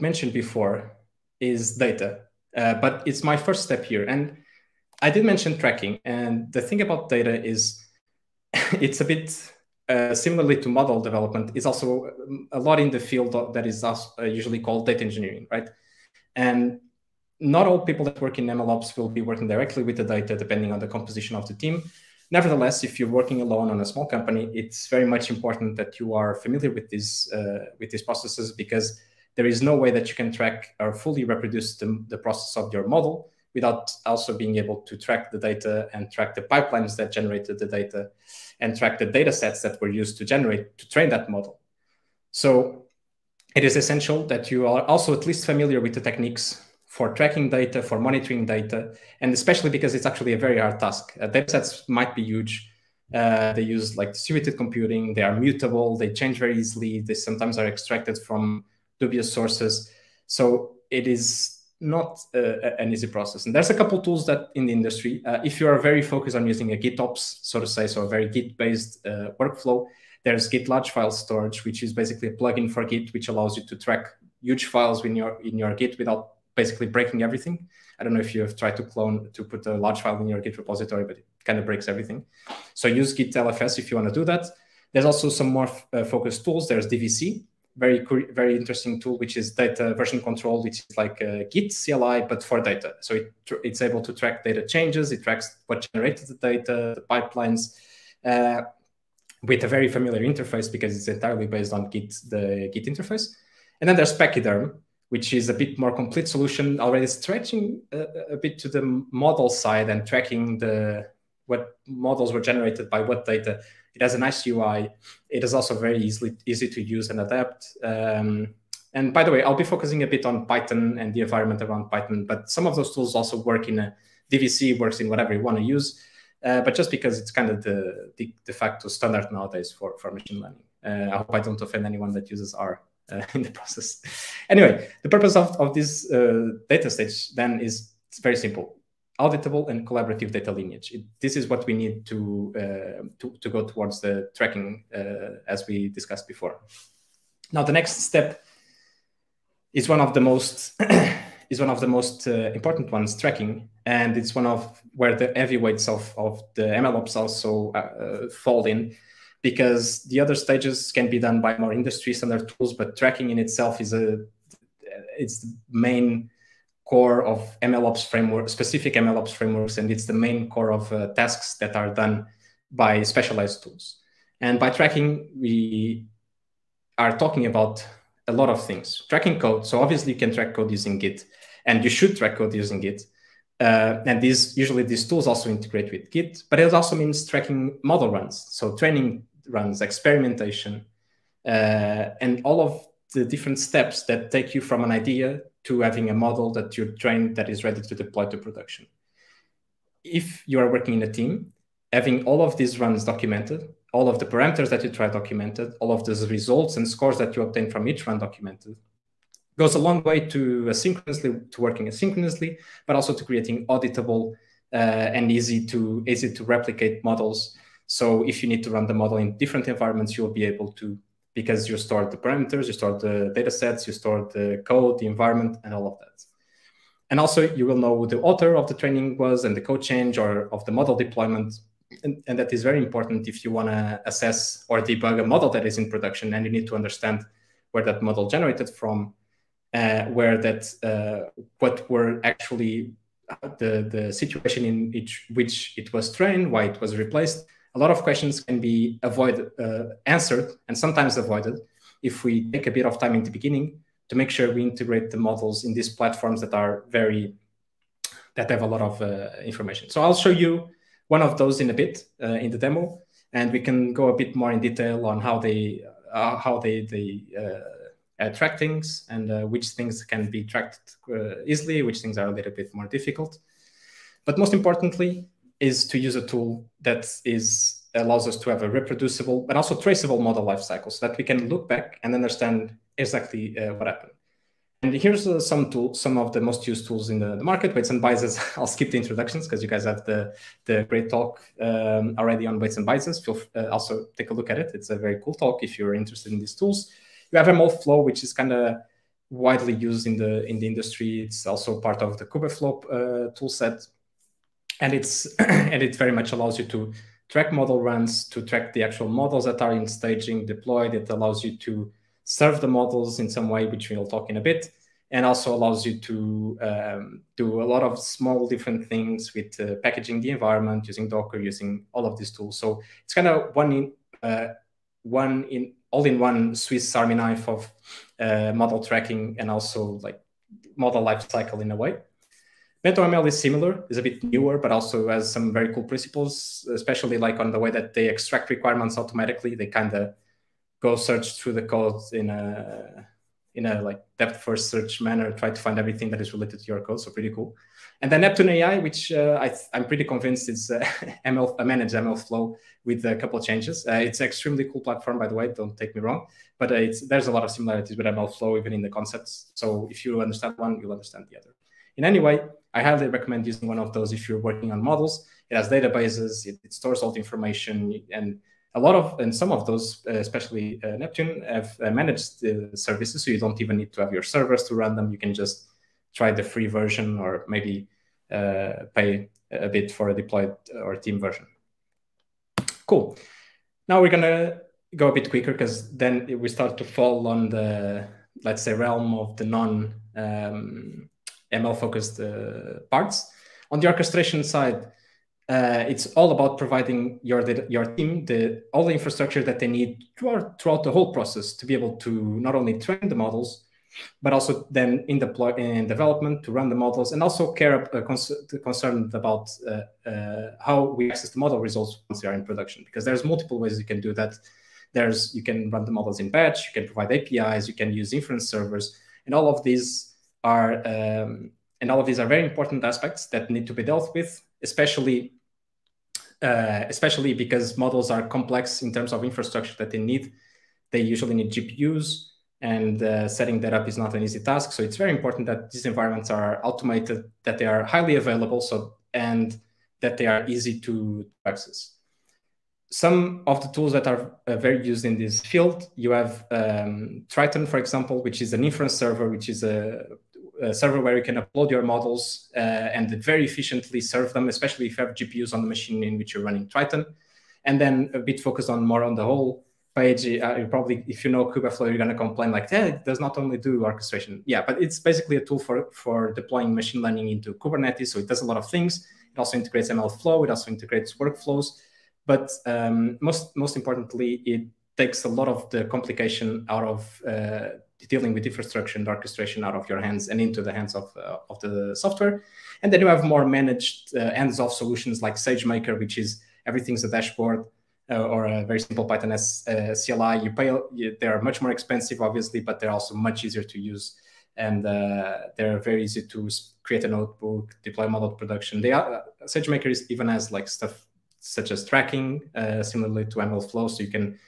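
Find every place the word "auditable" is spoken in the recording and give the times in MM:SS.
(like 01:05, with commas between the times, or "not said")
02:19, 03:33.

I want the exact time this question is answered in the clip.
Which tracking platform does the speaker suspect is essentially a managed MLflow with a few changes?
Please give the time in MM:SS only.
05:48.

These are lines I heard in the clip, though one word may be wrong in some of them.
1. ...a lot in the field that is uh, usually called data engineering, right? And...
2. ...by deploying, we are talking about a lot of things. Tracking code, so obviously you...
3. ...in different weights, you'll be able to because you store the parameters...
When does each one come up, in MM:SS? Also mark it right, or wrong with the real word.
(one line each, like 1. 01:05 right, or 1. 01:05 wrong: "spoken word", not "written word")
1. 00:12 right
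2. 02:54 wrong: "tracking", not "deploying"
3. 03:39 wrong: "environments", not "weights".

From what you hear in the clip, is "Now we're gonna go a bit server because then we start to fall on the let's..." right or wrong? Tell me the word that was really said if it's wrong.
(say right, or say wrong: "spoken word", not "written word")
wrong: "quicker", not "server".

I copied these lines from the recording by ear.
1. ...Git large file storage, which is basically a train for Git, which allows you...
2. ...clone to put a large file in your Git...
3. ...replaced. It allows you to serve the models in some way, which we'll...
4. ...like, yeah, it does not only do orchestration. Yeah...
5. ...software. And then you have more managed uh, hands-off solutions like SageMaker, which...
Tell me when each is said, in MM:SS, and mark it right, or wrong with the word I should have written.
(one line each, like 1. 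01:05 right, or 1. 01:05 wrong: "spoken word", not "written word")
1. 01:10 wrong: "plugin", not "train"
2. 01:18 right
3. 05:10 wrong: "deployed", not "replaced"
4. 07:42 right
5. 08:01 right.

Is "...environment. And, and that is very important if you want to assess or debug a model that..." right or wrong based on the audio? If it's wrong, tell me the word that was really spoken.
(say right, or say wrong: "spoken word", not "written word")
wrong: "deployment", not "environment".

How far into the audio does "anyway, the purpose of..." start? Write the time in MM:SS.
02:14.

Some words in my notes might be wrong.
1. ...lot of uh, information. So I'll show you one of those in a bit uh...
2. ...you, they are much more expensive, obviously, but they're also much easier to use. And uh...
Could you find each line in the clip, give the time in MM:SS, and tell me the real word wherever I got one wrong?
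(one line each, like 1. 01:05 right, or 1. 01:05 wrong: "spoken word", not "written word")
1. 04:18 right
2. 08:10 right.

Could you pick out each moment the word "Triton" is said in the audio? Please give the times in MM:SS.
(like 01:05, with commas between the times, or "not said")
07:27, 07:36.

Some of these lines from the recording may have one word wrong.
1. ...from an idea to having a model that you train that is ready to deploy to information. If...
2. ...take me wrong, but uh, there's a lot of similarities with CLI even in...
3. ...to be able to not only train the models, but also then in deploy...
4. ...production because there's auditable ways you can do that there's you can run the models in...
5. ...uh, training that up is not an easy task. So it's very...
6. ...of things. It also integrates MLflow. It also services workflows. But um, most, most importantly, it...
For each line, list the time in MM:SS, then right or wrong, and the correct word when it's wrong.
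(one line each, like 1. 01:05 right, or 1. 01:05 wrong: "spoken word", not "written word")
1. 03:14 wrong: "production", not "information"
2. 05:55 wrong: "MLflow", not "CLI"
3. 06:41 right
4. 06:52 wrong: "multiple", not "auditable"
5. 07:13 wrong: "setting", not "training"
6. 07:48 wrong: "integrates", not "services".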